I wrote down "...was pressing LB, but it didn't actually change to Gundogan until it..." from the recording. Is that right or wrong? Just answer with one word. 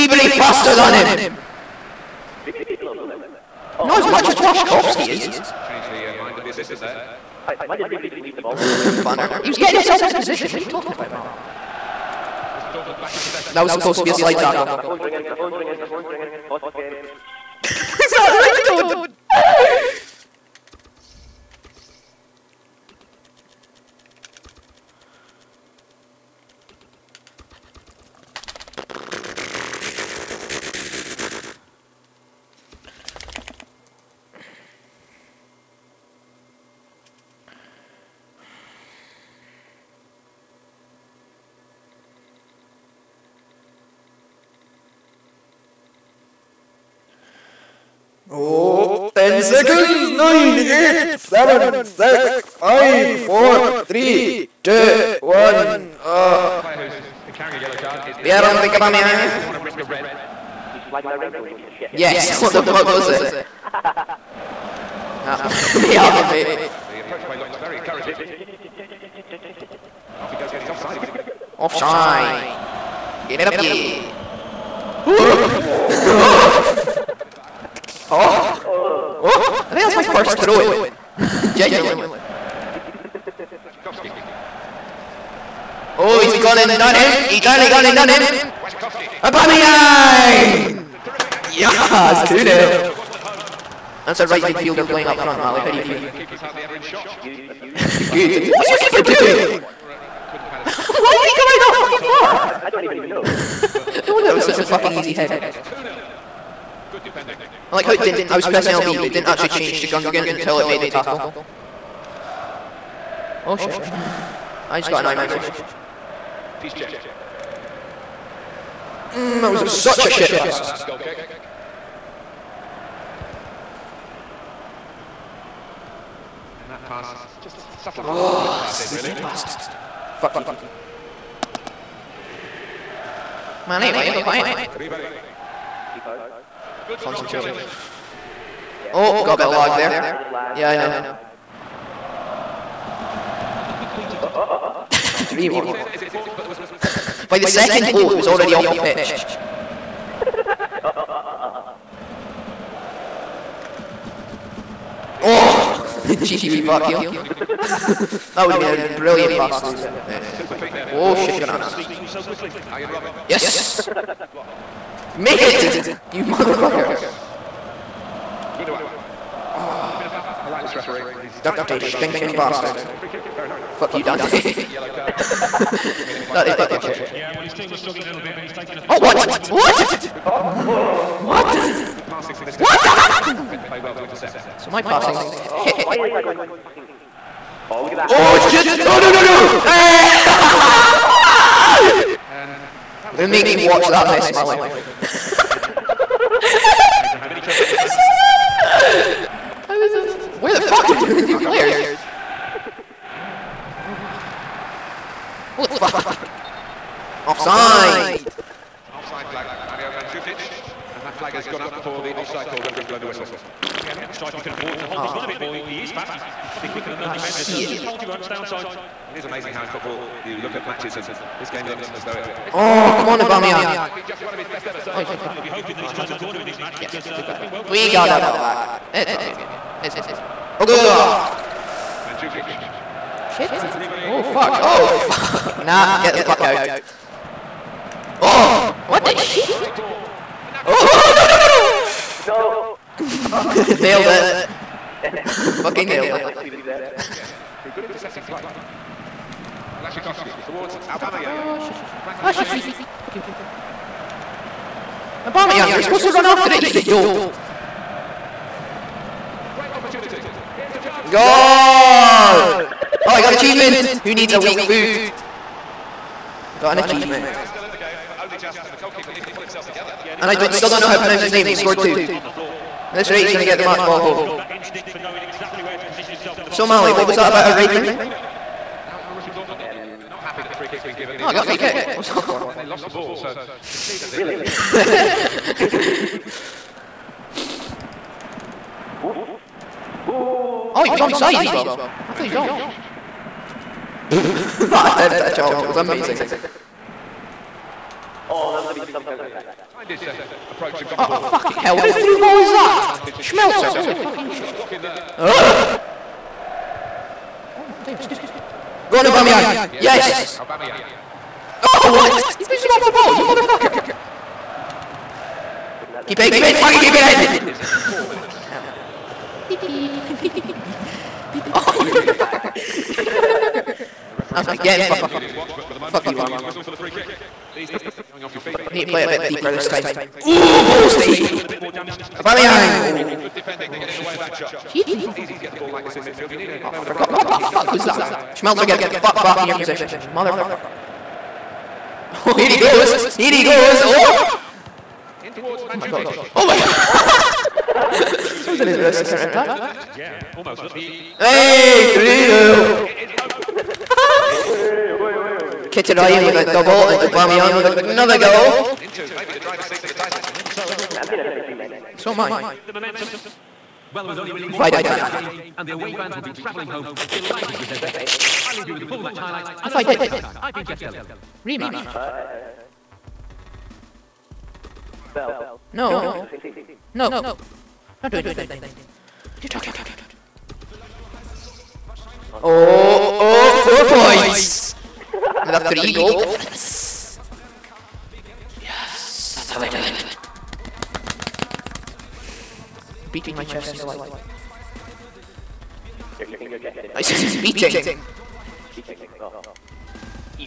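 right.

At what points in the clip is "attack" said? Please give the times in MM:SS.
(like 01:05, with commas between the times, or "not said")
04:59, 05:49.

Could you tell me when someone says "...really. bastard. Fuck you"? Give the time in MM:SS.
02:08.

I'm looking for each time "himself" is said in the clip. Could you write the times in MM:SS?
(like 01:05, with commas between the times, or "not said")
00:09, 04:29, 04:36.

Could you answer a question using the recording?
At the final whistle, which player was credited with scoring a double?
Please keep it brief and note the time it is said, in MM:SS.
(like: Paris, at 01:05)
Mkhitaryan, at 05:55.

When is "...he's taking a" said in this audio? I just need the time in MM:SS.
02:58.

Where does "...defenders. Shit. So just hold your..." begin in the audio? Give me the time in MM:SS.
03:37.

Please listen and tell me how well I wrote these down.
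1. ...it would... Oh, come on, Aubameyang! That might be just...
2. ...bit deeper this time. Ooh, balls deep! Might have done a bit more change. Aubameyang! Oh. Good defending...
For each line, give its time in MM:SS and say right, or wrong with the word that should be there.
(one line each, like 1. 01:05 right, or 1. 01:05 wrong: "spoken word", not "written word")
1. 03:42 right
2. 05:29 wrong: "damage", not "change".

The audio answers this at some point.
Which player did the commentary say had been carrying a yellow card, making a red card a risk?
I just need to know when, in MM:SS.
00:58.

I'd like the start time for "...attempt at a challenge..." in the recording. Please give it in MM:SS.
04:54.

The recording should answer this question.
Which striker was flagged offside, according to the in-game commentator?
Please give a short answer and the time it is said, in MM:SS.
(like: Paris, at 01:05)
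Mario Mandzukic, at 03:29.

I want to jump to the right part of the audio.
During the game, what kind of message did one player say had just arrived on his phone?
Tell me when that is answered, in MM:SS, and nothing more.
01:55.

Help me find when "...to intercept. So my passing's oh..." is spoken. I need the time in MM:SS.
03:03.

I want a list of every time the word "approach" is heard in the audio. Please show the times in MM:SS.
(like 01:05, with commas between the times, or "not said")
01:07, 05:00.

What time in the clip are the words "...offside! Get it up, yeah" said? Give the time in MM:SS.
01:11.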